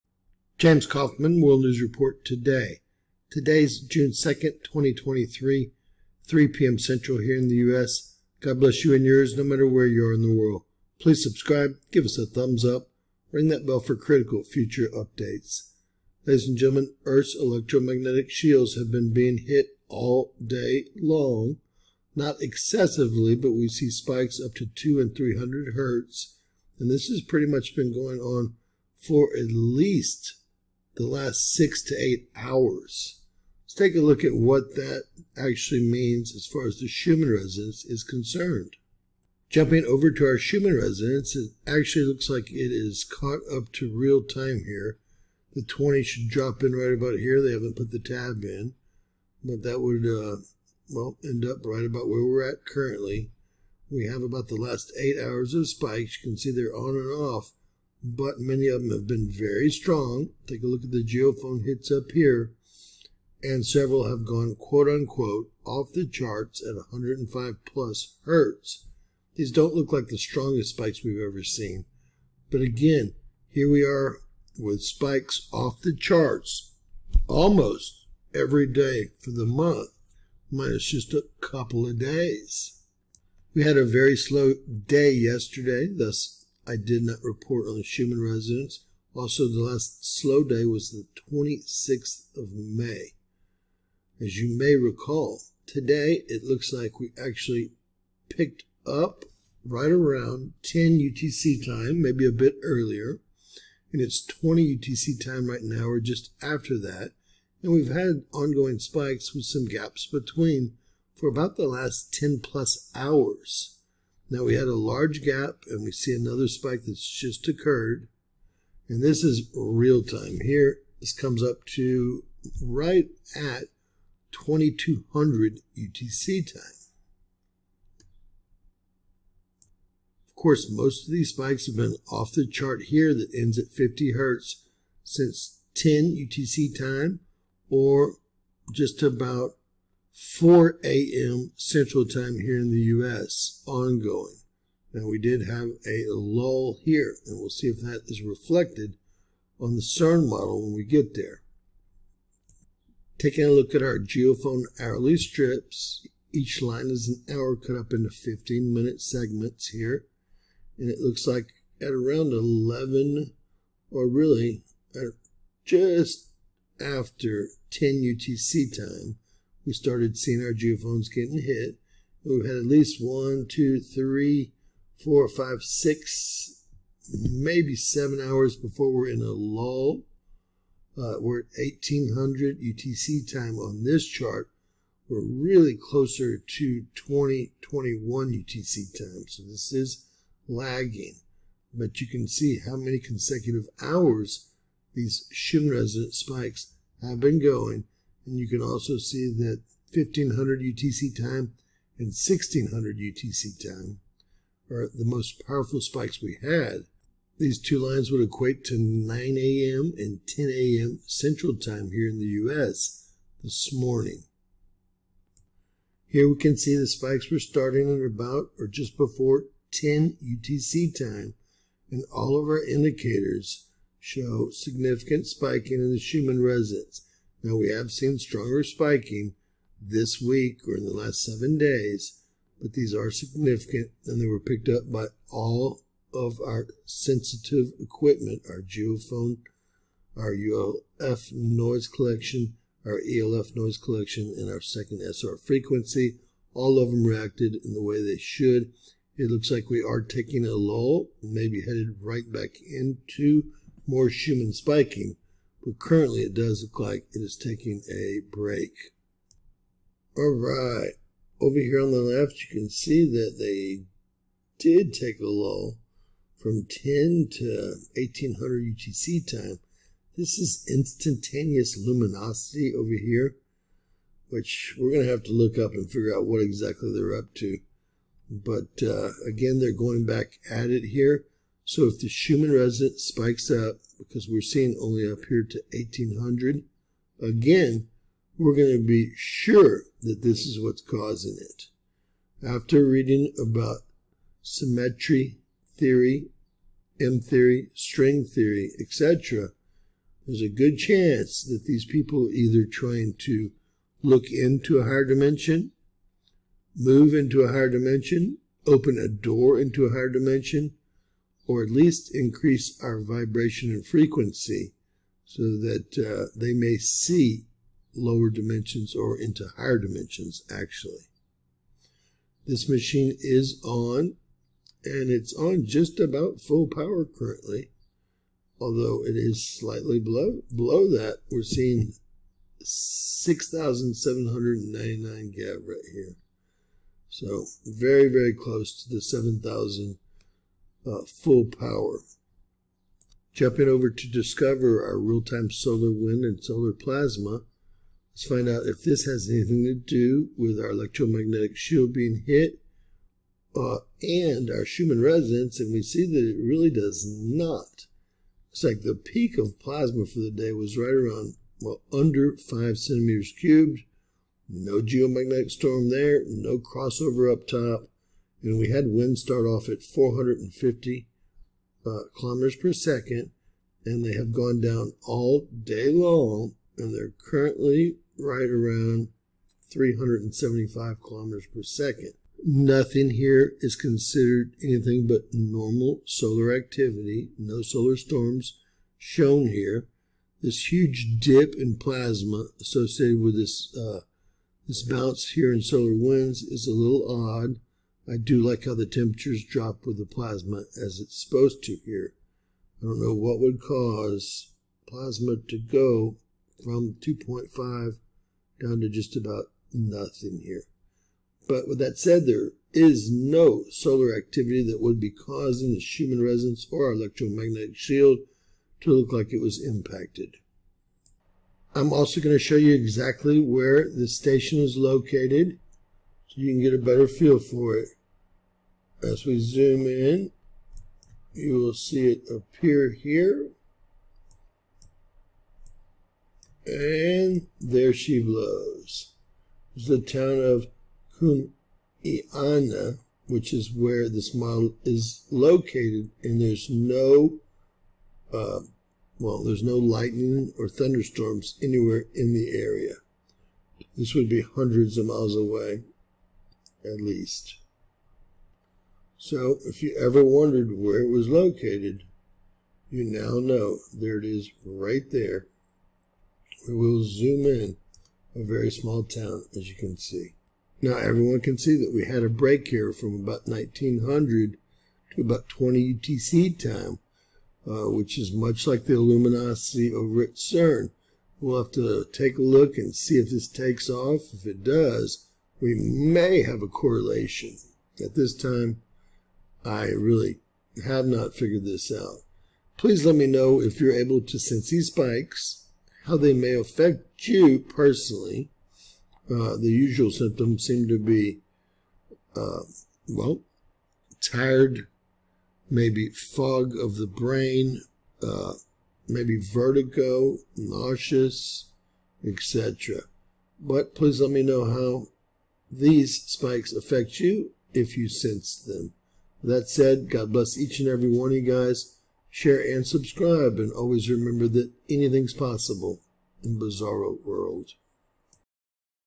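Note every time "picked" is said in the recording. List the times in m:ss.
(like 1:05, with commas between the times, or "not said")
1:38, 3:54.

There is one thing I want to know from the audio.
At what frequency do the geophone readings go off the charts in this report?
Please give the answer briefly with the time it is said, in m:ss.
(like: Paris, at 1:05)
105 Hz, at 1:06.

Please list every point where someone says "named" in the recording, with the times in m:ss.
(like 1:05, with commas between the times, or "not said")
not said.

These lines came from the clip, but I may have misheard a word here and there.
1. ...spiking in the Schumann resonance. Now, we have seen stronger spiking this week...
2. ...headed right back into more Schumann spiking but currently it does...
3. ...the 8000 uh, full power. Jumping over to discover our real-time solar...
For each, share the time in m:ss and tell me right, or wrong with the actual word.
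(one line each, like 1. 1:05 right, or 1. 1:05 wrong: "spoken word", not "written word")
1. 3:45 right
2. 4:11 right
3. 5:38 wrong: "7000", not "8000".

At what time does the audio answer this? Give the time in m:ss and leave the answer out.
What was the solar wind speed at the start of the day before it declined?
6:09.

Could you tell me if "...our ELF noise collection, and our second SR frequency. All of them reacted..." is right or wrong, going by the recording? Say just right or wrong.
right.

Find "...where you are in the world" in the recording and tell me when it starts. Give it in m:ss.
0:09.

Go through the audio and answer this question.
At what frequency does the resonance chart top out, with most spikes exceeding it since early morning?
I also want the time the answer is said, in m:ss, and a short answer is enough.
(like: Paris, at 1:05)
50 Hz, at 2:13.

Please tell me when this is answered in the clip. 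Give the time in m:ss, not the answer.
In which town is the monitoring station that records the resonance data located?
7:21.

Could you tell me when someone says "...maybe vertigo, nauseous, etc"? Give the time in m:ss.
8:29.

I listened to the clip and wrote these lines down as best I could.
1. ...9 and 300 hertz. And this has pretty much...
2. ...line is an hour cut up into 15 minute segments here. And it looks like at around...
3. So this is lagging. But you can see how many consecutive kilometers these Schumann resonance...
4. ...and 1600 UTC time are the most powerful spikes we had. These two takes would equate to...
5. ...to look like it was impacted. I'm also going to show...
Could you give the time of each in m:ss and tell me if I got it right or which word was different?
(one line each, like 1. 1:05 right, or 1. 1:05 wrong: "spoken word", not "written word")
1. 0:24 wrong: "2", not "9"
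2. 2:36 right
3. 3:09 wrong: "hours", not "kilometers"
4. 3:21 wrong: "lines", not "takes"
5. 6:58 right.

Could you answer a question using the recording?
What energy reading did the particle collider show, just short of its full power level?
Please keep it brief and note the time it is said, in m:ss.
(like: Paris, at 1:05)
6799 GeV, at 5:32.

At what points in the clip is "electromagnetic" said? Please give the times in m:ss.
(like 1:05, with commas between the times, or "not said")
0:17, 5:50, 6:56.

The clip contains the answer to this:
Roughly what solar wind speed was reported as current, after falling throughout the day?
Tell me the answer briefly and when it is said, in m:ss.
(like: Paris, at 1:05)
375 km/s, at 6:19.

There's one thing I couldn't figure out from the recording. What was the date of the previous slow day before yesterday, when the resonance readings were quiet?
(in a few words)
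May 26.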